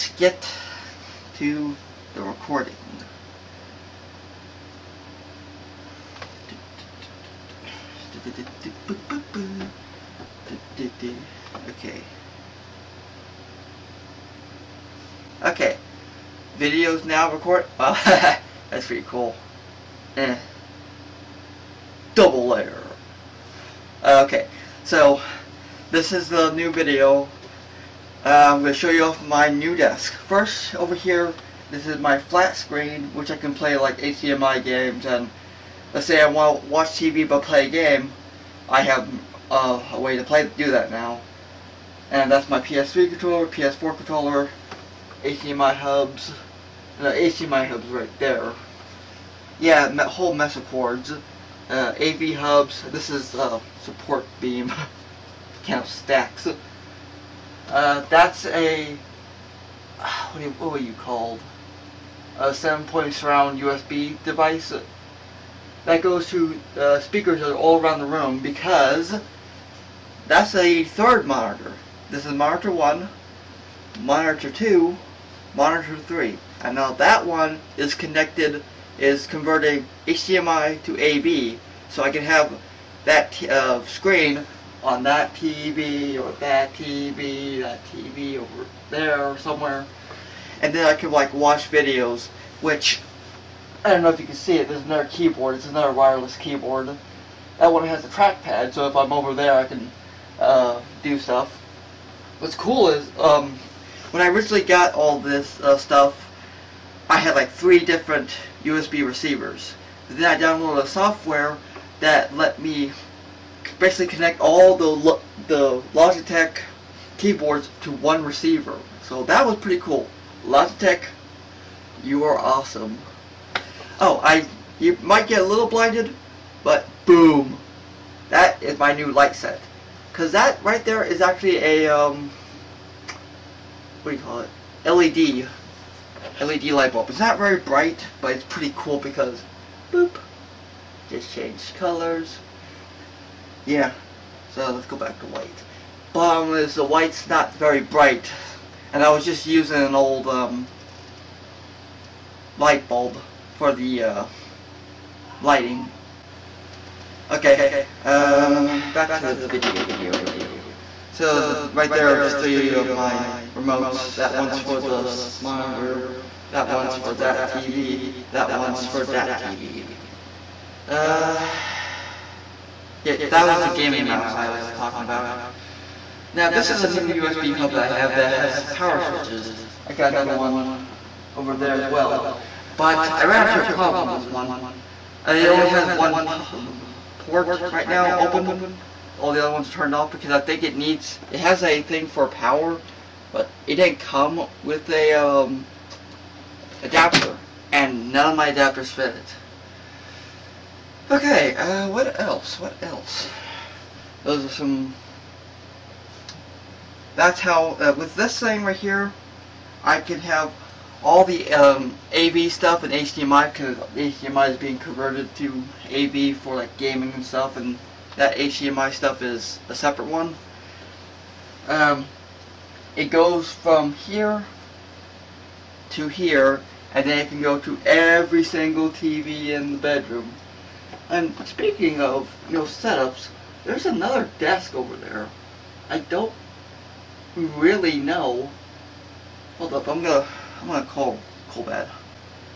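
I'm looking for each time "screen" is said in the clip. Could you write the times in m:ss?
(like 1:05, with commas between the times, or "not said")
0:32, 1:23.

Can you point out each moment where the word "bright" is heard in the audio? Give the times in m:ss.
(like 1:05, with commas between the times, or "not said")
2:17, 2:27.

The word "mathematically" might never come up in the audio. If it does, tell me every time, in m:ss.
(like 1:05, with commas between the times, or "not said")
not said.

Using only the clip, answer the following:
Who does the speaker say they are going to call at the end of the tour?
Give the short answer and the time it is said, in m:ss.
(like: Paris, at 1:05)
CoolBad, at 4:01.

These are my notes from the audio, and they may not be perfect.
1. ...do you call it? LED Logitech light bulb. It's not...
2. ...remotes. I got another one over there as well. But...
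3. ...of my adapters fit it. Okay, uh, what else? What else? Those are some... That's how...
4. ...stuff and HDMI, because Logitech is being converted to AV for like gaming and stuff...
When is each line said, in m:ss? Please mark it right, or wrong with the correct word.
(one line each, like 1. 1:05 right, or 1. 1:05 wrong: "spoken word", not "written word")
1. 2:14 wrong: "LED", not "Logitech"
2. 2:59 wrong: "switches", not "remotes"
3. 3:18 right
4. 3:32 wrong: "HDMI", not "Logitech".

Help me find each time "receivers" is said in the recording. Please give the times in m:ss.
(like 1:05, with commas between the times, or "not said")
1:49, 1:58.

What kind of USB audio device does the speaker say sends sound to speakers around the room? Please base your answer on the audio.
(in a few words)
Seven-point surround.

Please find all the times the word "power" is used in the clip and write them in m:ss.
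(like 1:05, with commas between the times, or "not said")
2:58, 3:12.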